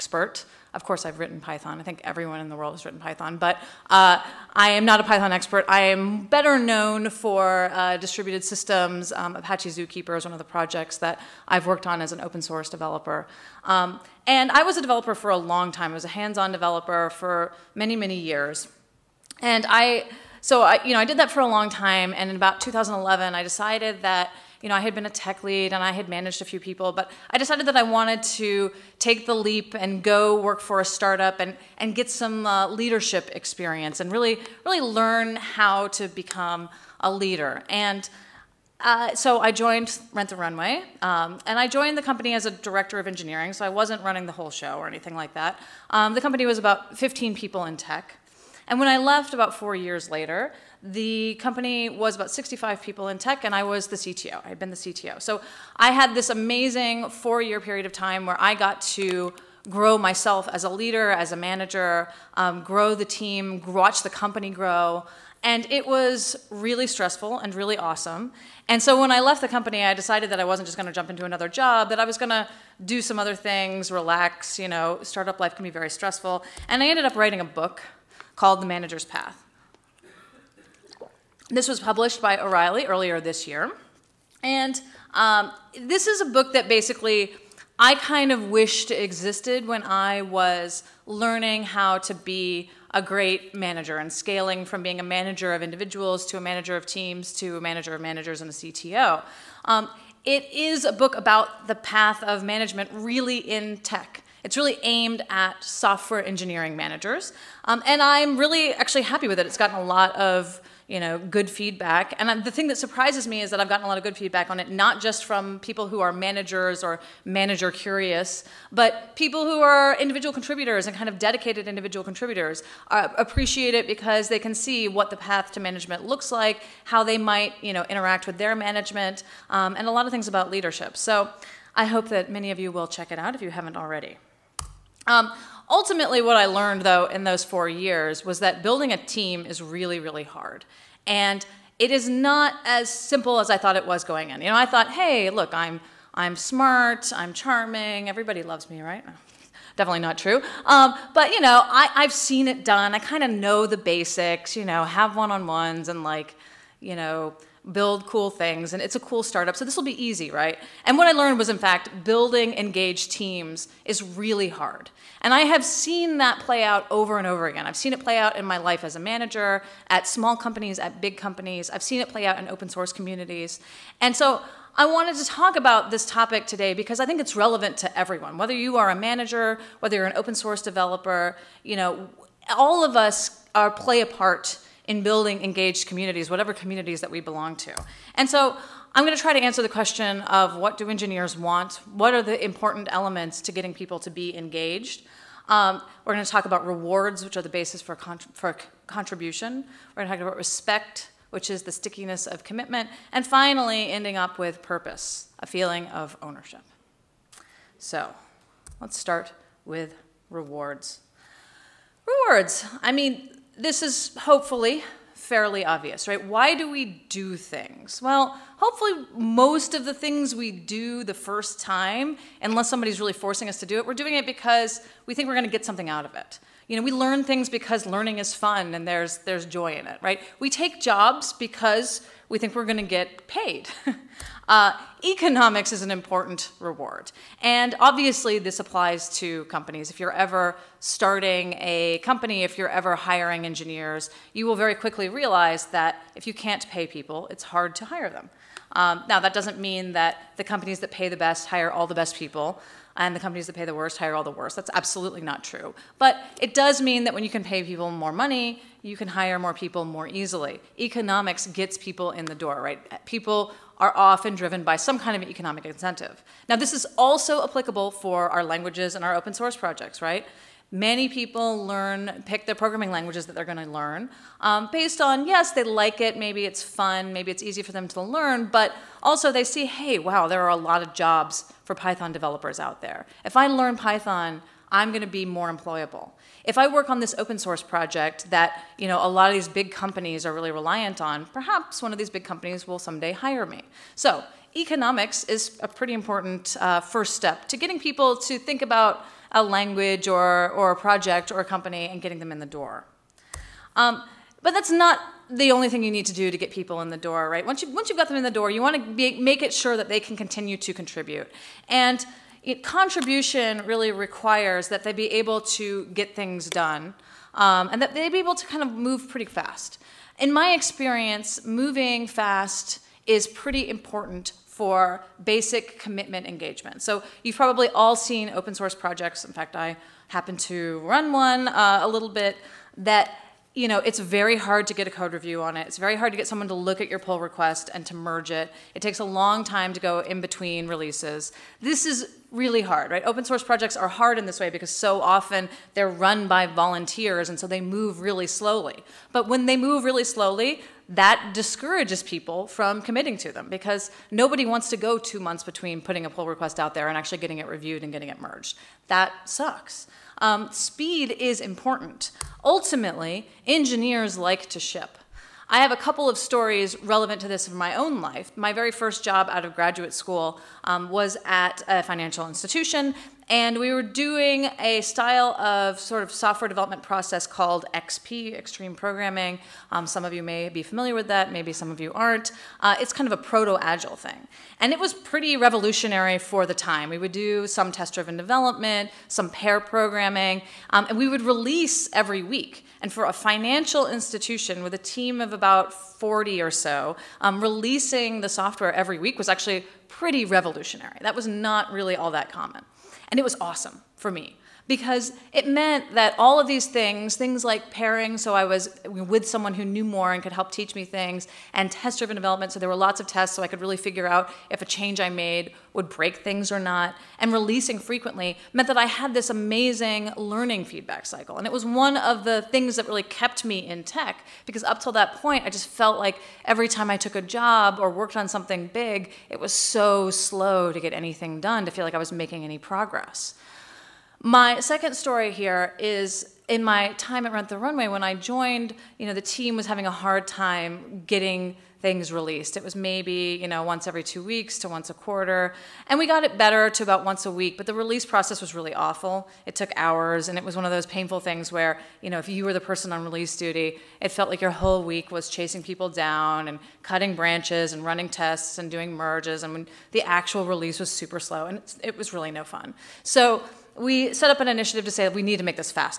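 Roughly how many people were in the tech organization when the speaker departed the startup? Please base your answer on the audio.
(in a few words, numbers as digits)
65.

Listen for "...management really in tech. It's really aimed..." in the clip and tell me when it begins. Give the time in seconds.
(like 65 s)
102 s.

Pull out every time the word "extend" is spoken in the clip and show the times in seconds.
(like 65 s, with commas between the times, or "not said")
not said.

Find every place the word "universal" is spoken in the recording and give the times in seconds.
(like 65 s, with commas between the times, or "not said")
not said.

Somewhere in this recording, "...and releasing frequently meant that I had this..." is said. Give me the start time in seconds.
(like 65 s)
417 s.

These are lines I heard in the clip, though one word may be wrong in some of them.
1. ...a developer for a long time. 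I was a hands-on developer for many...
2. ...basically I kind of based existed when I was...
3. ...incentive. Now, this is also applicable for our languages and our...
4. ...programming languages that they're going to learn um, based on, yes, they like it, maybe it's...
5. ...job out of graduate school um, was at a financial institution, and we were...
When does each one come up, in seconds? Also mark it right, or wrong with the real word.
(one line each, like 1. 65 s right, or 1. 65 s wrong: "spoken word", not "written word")
1. 14 s right
2. 86 s wrong: "wished", not "based"
3. 265 s right
4. 272 s right
5. 369 s right.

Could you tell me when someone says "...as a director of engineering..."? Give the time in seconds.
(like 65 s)
42 s.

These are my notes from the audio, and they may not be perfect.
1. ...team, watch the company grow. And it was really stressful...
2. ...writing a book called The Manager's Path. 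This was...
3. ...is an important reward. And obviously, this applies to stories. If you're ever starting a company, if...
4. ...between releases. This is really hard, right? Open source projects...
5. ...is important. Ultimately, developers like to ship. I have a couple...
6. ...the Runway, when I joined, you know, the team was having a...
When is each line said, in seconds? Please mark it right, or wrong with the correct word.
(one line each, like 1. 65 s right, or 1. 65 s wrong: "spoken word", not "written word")
1. 63 s right
2. 77 s right
3. 235 s wrong: "companies", not "stories"
4. 340 s right
5. 361 s wrong: "engineers", not "developers"
6. 437 s right.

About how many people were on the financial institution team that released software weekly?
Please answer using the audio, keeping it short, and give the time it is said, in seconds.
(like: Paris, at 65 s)
40, at 395 s.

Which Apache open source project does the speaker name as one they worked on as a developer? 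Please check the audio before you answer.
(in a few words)
Apache Zookeeper.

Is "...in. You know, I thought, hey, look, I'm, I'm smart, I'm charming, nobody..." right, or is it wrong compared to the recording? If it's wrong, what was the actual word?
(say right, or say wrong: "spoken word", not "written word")
wrong: "everybody", not "nobody".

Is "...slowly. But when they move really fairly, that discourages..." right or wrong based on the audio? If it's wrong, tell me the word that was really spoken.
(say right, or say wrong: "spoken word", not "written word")
wrong: "slowly", not "fairly".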